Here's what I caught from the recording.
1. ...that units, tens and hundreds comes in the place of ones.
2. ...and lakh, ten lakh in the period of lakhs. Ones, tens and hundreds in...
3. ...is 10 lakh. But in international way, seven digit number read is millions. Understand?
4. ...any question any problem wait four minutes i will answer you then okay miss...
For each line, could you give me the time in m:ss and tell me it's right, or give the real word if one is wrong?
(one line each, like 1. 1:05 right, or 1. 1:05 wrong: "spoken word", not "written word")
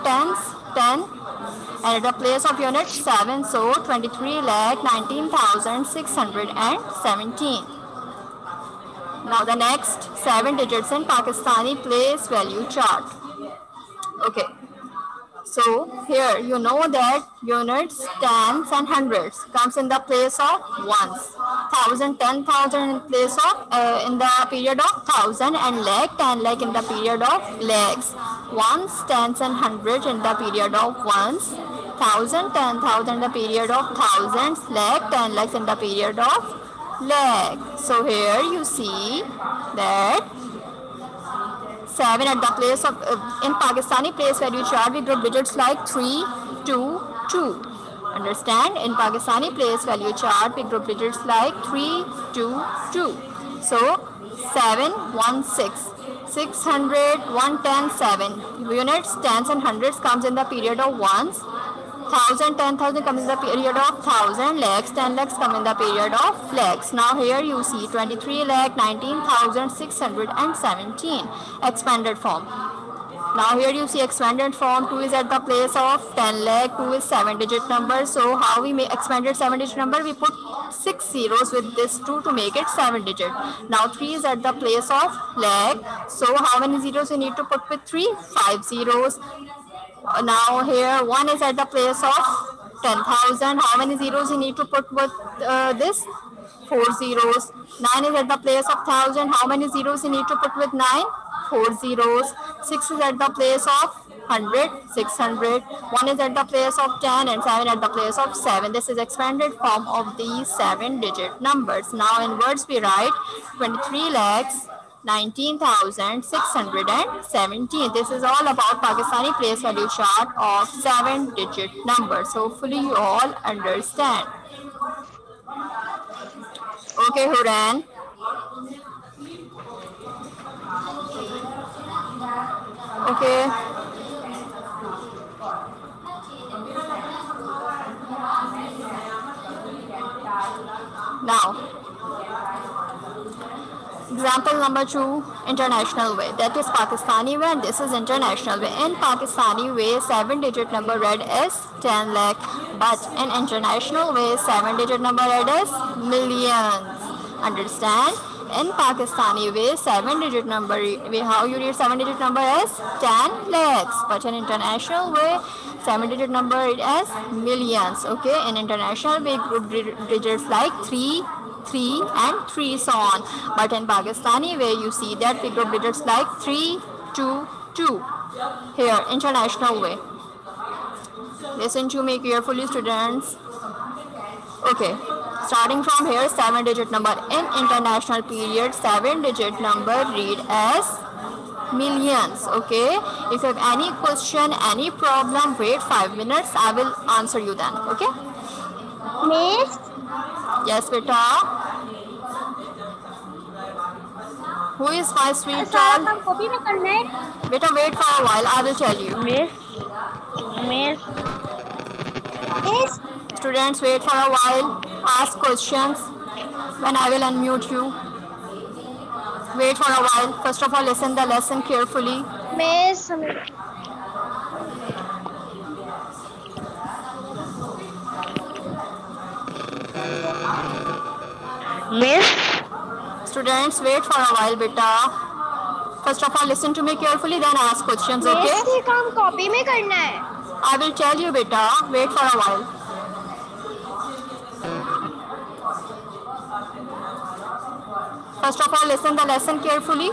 1. 0:16 right
2. 0:25 right
3. 2:31 right
4. 3:13 wrong: "five", not "four".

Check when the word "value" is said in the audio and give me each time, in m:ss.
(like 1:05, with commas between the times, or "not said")
0:12, 0:49, 1:59.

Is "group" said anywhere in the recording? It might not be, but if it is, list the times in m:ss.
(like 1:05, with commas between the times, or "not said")
0:45, 0:50, 2:49.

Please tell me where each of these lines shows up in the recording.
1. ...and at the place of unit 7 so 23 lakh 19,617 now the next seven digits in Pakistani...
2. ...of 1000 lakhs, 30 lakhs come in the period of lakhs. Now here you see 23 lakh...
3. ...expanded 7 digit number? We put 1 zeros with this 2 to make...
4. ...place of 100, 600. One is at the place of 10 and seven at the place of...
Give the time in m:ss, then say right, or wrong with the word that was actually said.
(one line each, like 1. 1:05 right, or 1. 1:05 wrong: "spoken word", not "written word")
1. 0:01 right
2. 1:03 wrong: "10", not "30"
3. 1:18 wrong: "6", not "1"
4. 1:43 right.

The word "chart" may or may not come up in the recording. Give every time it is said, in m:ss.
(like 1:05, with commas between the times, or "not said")
0:12, 0:44, 0:50, 1:59.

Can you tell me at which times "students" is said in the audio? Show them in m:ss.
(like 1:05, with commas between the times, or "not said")
3:02, 3:33, 3:53.